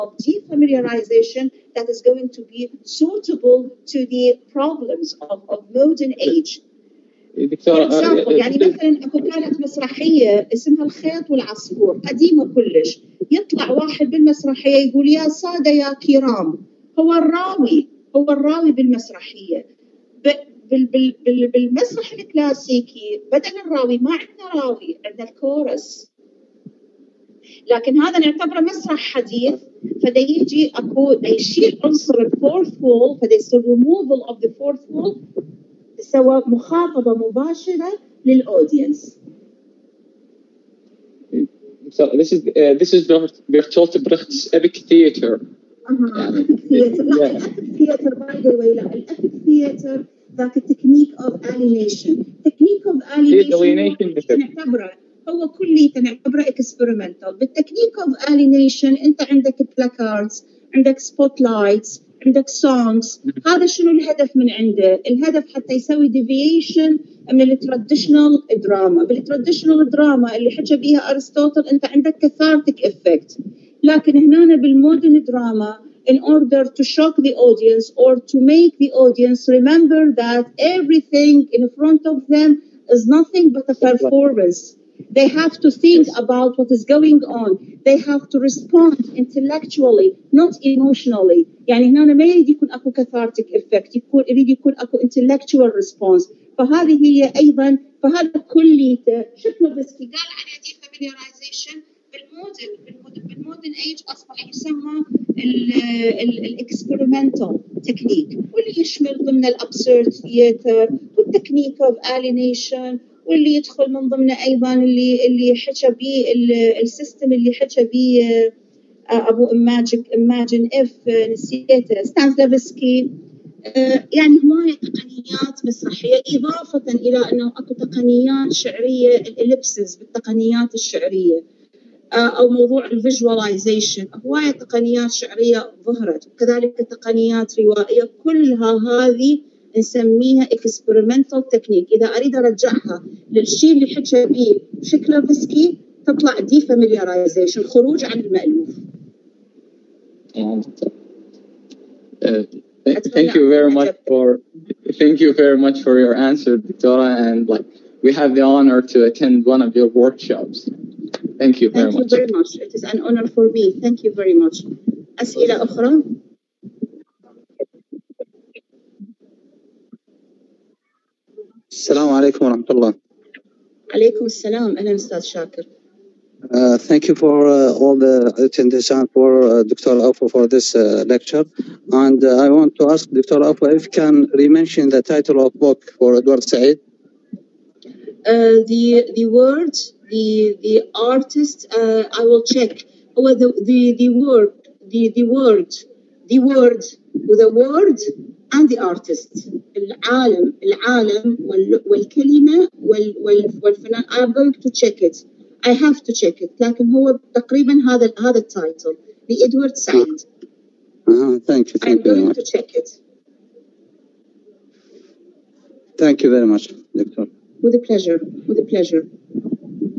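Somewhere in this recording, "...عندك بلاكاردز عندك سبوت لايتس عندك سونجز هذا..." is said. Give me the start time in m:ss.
0:59.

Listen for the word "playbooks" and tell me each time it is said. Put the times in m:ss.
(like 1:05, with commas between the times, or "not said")
not said.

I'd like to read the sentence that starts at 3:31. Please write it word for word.
Thank I'm you going to check it.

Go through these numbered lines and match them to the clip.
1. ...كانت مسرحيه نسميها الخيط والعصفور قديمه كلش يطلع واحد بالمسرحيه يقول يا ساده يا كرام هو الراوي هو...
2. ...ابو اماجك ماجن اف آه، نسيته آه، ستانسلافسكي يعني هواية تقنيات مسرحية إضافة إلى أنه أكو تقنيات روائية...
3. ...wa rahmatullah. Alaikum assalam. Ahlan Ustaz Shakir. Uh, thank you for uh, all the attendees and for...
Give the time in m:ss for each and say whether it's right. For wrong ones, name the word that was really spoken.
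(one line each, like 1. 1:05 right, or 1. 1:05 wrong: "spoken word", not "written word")
1. 0:09 wrong: "اسمها", not "نسميها"
2. 1:59 wrong: "شعرية", not "روائية"
3. 2:52 right.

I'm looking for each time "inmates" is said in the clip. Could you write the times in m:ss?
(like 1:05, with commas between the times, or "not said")
not said.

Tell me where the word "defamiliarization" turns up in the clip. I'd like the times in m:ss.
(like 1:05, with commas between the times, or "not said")
0:00, 1:40.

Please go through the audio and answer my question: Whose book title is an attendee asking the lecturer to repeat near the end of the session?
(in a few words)
Edward Said.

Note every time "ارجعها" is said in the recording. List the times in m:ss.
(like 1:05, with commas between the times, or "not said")
2:22.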